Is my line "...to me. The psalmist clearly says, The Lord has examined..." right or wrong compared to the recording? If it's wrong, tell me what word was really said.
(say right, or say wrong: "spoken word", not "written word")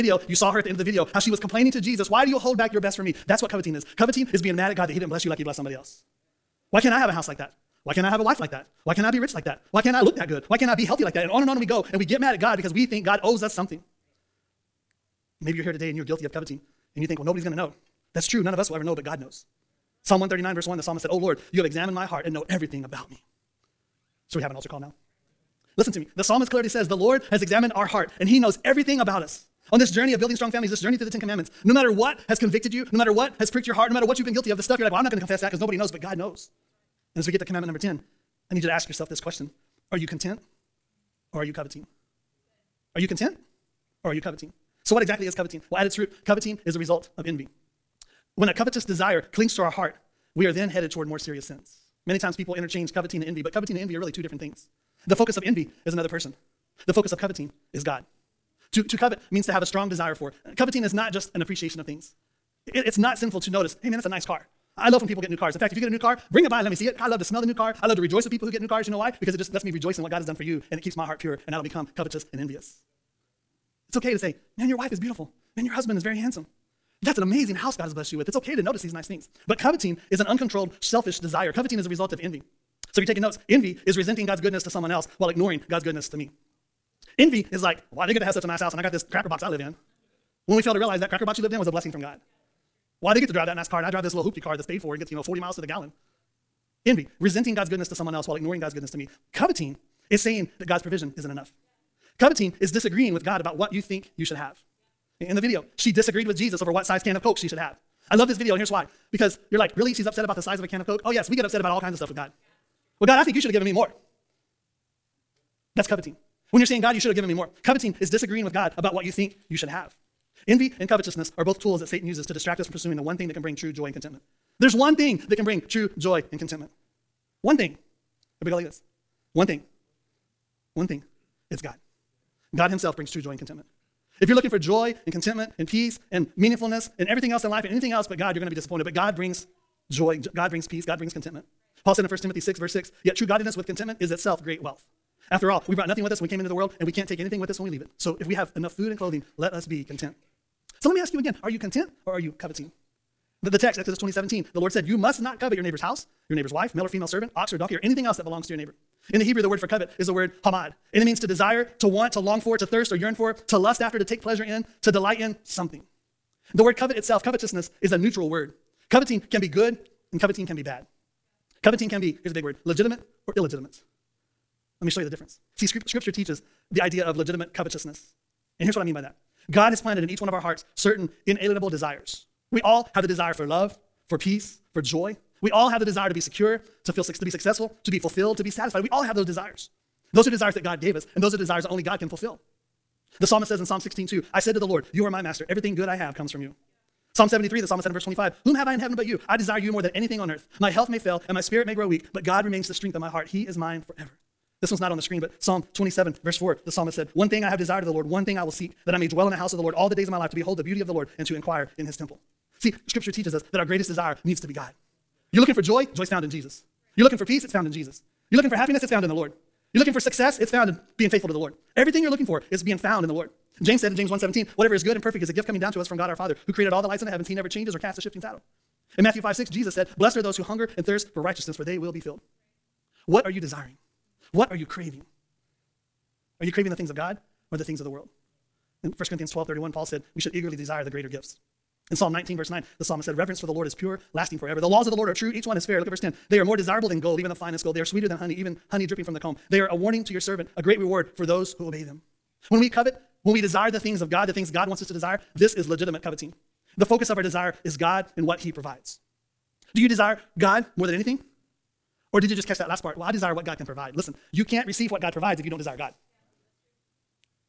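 right.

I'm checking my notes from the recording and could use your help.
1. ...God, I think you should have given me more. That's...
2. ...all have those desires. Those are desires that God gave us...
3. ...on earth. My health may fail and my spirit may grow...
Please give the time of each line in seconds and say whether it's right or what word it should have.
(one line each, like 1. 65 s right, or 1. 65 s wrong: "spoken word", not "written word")
1. 113 s right
2. 188 s right
3. 200 s right.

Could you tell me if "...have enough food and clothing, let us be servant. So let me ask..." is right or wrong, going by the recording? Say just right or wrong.
wrong.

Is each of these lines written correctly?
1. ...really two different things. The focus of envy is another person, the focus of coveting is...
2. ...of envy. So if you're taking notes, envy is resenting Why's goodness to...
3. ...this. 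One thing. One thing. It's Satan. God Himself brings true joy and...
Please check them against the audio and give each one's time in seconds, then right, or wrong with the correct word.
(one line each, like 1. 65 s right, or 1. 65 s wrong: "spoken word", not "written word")
1. 53 s right
2. 82 s wrong: "God", not "Why"
3. 128 s wrong: "God", not "Satan".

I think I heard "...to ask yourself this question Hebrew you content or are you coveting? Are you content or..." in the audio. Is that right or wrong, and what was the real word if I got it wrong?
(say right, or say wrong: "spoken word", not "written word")
wrong: "Are", not "Hebrew".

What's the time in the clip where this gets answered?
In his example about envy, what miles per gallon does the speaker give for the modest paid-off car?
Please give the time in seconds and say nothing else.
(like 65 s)
95 s.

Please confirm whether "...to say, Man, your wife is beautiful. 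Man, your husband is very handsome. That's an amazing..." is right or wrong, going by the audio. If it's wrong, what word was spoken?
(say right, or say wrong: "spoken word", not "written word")
right.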